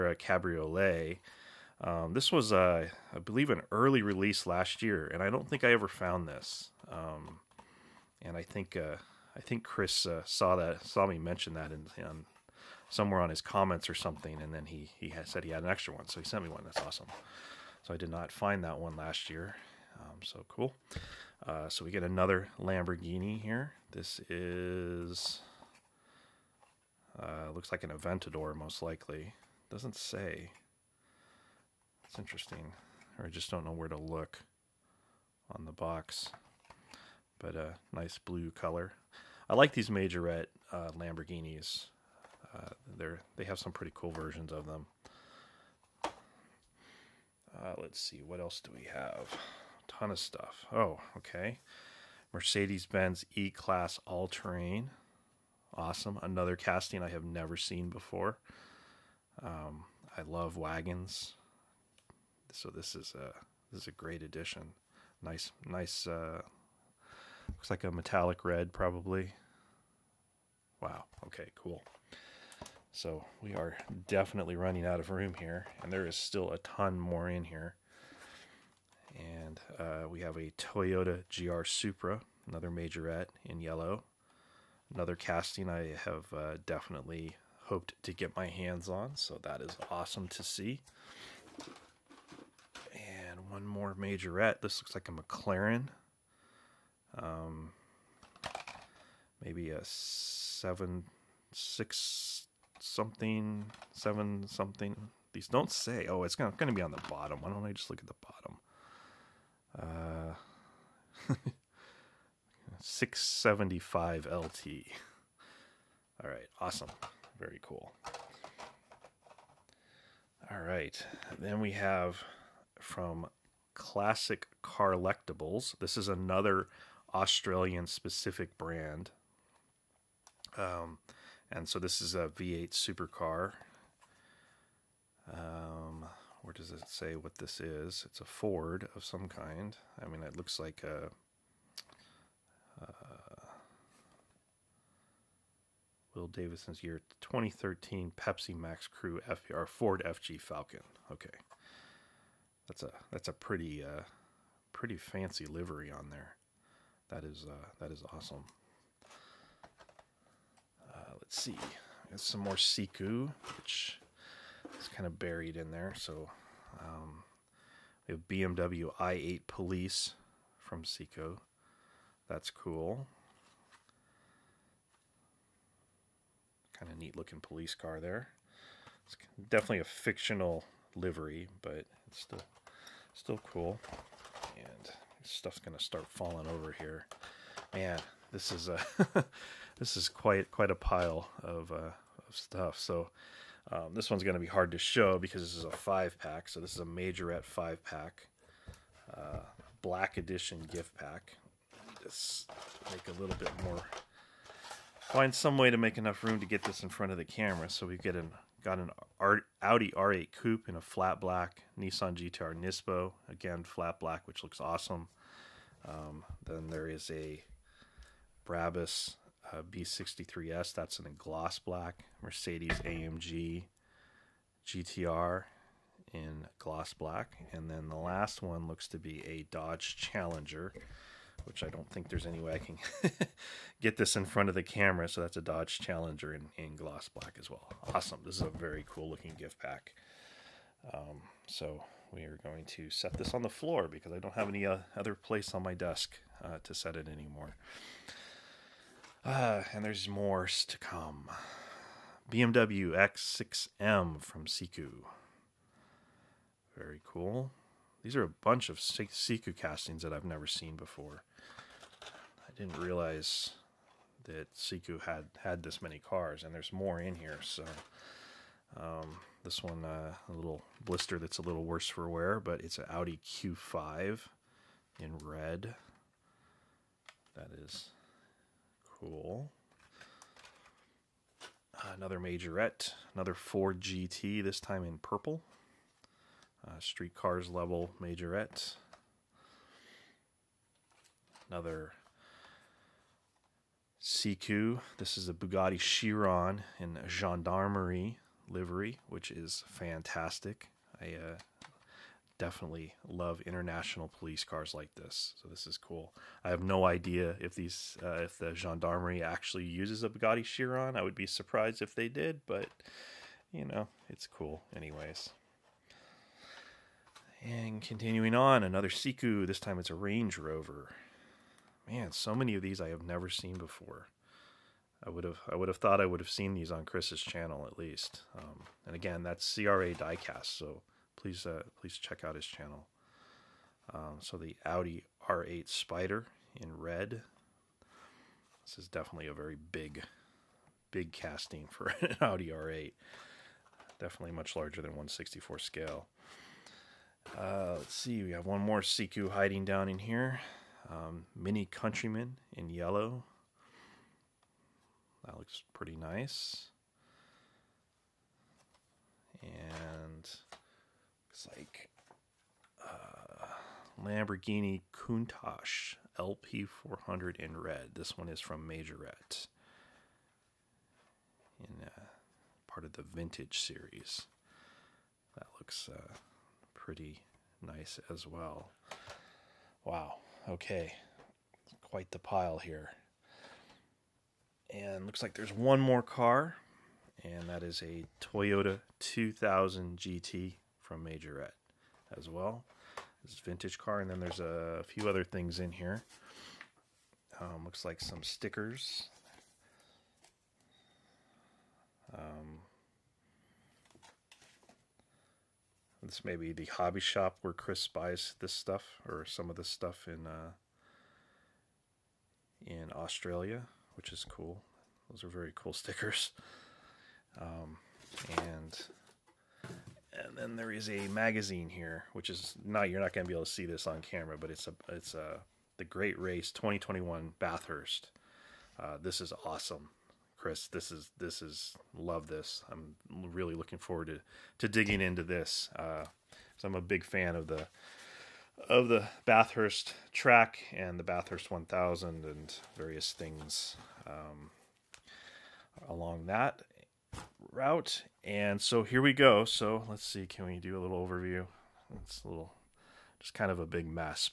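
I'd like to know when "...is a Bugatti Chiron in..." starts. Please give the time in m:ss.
4:55.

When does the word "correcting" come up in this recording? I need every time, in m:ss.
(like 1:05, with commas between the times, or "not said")
not said.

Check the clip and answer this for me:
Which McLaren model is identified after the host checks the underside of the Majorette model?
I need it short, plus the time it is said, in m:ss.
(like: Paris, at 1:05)
675 LT, at 1:52.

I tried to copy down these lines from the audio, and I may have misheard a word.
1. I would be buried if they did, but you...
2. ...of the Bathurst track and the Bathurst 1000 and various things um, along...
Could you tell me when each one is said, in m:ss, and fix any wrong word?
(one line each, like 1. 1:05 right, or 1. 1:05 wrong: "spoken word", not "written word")
1. 5:10 wrong: "surprised", not "buried"
2. 7:18 right.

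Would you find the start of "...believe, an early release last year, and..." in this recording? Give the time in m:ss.
0:03.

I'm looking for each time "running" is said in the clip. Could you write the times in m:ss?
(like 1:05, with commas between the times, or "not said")
1:14.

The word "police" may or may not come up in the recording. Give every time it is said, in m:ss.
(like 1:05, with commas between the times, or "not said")
2:49, 2:57, 5:04.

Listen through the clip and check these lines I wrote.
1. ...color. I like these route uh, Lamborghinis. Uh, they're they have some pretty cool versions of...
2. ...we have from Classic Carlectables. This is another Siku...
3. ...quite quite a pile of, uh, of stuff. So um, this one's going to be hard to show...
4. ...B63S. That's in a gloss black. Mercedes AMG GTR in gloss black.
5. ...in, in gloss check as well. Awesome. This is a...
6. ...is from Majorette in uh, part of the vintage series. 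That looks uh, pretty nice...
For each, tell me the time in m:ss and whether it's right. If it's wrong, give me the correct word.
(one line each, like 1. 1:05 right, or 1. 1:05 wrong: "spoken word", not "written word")
1. 0:38 wrong: "majorette", not "route"
2. 2:01 wrong: "Australian", not "Siku"
3. 3:10 right
4. 3:39 right
5. 3:56 wrong: "black", not "check"
6. 6:08 right.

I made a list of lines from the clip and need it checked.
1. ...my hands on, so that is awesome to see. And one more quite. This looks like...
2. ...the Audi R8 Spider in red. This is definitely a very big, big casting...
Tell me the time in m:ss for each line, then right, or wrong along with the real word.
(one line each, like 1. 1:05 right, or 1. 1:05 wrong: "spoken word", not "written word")
1. 1:28 wrong: "majorette", not "quite"
2. 5:34 right.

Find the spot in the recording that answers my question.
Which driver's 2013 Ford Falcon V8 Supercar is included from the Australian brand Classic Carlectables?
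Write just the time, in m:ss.
2:26.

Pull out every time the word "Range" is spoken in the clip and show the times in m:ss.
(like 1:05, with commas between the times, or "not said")
5:19.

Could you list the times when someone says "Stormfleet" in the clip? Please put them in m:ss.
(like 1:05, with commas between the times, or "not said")
not said.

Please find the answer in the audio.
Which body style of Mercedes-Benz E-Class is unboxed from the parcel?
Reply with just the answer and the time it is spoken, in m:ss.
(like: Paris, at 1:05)
All Terrain, at 0:54.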